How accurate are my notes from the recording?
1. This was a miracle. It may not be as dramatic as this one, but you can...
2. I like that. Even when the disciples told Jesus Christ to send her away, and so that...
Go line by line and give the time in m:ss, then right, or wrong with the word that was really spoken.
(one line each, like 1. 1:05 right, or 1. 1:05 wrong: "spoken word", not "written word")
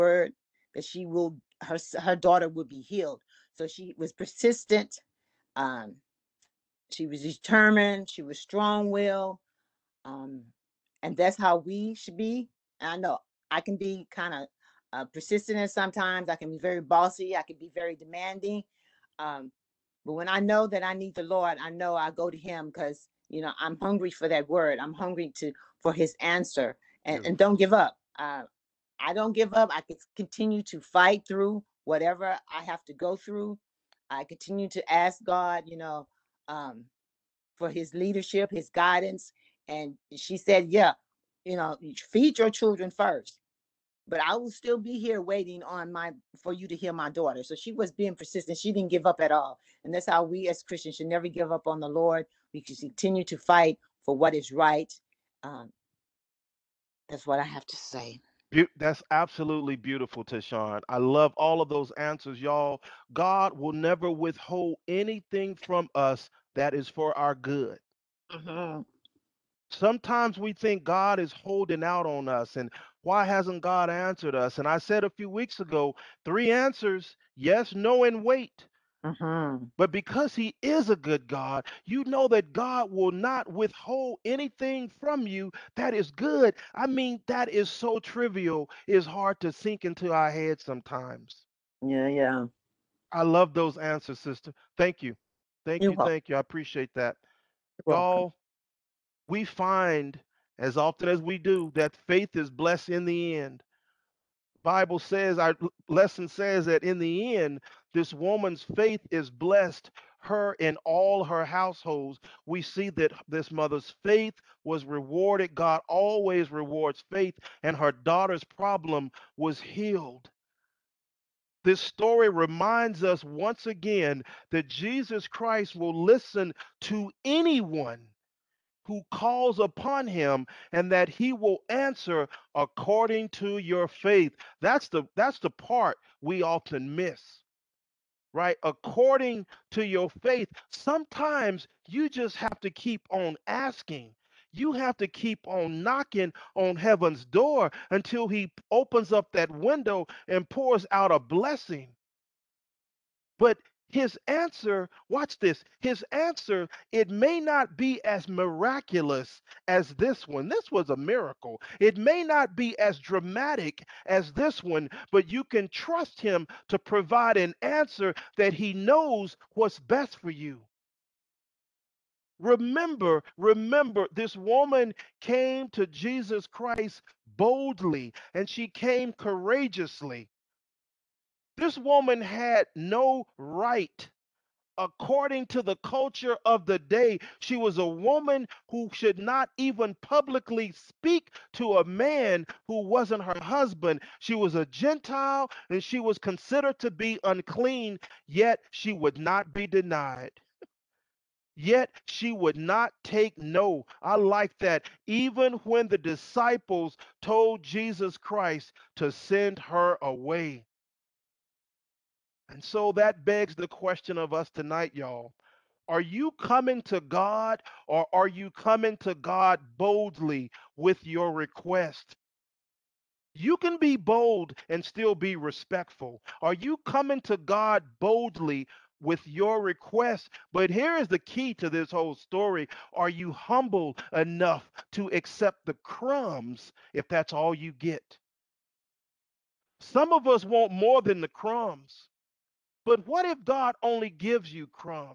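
1. 2:40 right
2. 3:24 right.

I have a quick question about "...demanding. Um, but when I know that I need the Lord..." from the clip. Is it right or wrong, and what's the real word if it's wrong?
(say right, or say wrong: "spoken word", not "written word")
right.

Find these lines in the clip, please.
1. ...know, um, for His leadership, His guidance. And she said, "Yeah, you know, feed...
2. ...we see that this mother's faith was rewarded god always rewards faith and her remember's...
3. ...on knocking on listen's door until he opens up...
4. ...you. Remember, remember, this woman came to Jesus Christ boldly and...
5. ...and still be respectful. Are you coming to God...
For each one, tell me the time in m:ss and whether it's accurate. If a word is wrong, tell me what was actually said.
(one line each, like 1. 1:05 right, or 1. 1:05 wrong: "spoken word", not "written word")
1. 0:35 right
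2. 1:52 wrong: "daughter", not "remember"
3. 2:25 wrong: "heaven", not "listen"
4. 2:50 right
5. 3:44 right.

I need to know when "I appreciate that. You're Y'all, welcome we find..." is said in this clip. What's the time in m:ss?
1:36.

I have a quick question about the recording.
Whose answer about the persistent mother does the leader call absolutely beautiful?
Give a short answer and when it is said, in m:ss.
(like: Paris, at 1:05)
Tashawn, at 1:00.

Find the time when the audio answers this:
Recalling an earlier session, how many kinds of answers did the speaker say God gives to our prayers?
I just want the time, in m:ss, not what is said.
1:16.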